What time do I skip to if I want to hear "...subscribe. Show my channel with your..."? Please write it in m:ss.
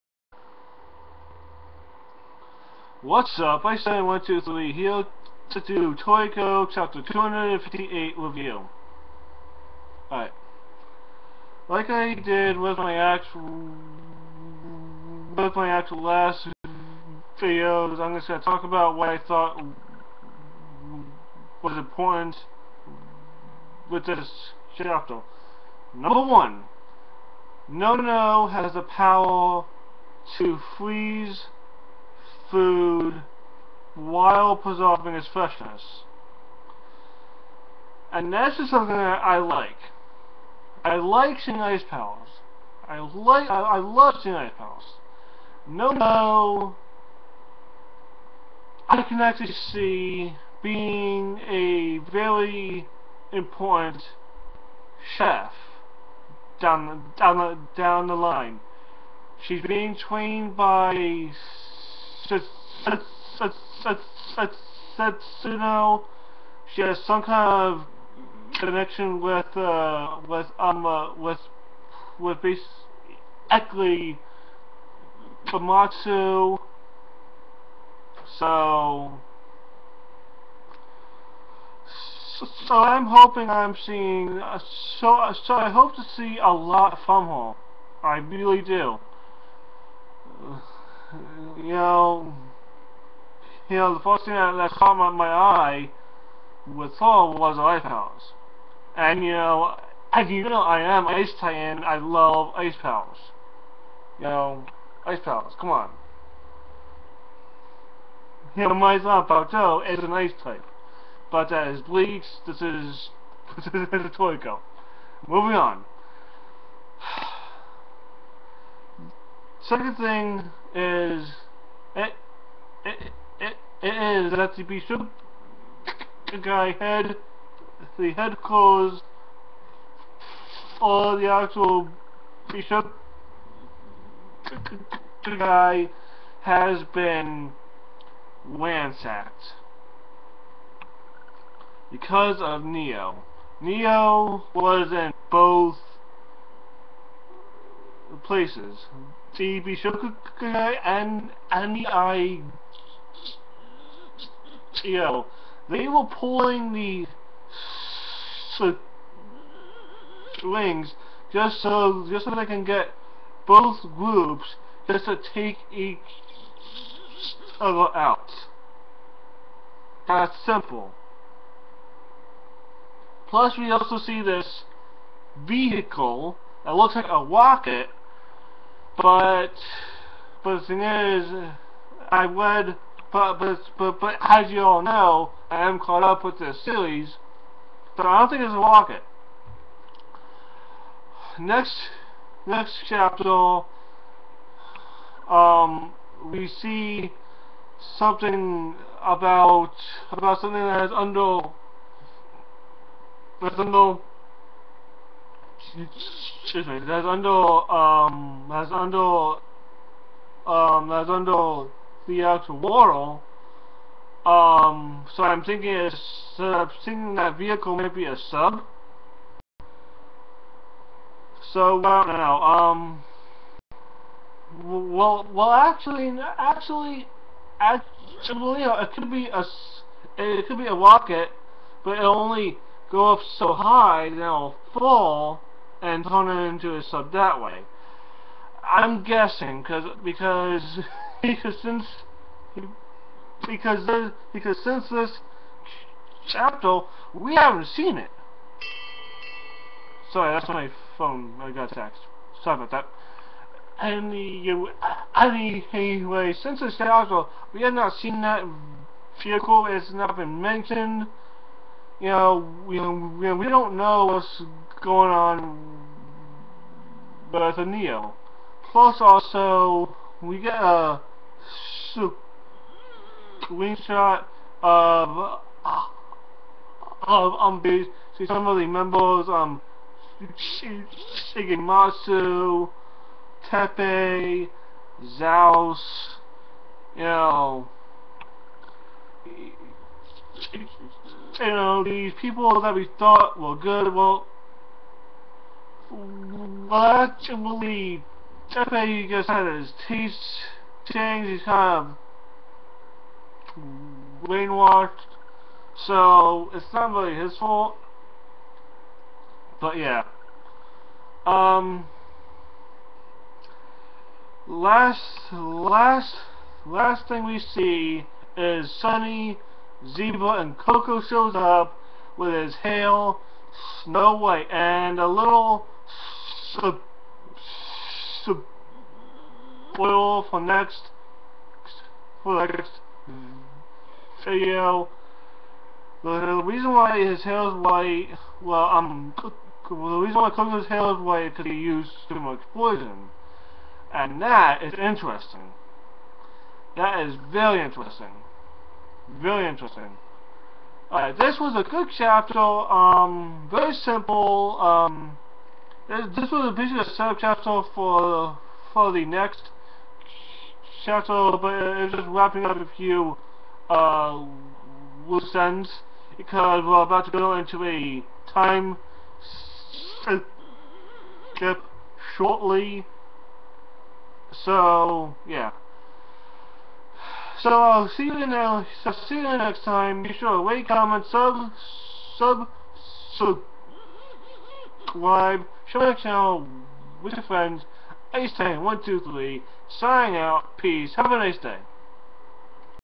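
6:23.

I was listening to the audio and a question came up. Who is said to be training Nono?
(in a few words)
Sentinel.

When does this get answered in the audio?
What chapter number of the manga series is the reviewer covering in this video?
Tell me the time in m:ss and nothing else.
0:07.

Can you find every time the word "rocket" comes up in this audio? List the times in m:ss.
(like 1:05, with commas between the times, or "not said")
2:57, 3:50.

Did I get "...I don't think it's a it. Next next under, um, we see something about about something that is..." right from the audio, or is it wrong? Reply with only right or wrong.
wrong.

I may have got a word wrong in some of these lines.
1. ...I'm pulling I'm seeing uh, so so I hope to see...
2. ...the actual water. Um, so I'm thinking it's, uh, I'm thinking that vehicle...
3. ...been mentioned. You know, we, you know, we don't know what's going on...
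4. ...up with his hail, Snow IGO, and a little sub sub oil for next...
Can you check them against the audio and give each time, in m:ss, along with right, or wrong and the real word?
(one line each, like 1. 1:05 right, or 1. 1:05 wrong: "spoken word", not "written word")
1. 1:22 wrong: "hoping", not "pulling"
2. 3:32 right
3. 4:20 right
4. 5:21 wrong: "White", not "IGO".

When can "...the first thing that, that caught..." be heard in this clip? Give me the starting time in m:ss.
1:33.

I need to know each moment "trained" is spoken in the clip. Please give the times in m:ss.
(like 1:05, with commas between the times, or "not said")
0:59.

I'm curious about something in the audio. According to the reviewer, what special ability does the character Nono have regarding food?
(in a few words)
Freeze food.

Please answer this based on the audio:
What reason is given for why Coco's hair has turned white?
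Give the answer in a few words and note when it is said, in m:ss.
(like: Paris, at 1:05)
Too much poison, at 5:42.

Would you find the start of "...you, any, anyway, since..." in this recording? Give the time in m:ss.
4:14.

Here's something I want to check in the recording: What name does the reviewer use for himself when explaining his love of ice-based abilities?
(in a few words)
Ice Titan.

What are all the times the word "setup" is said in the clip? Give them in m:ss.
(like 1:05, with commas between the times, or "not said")
5:56.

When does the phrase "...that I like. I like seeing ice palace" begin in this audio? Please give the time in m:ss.
0:38.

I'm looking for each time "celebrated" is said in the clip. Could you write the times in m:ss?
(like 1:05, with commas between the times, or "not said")
not said.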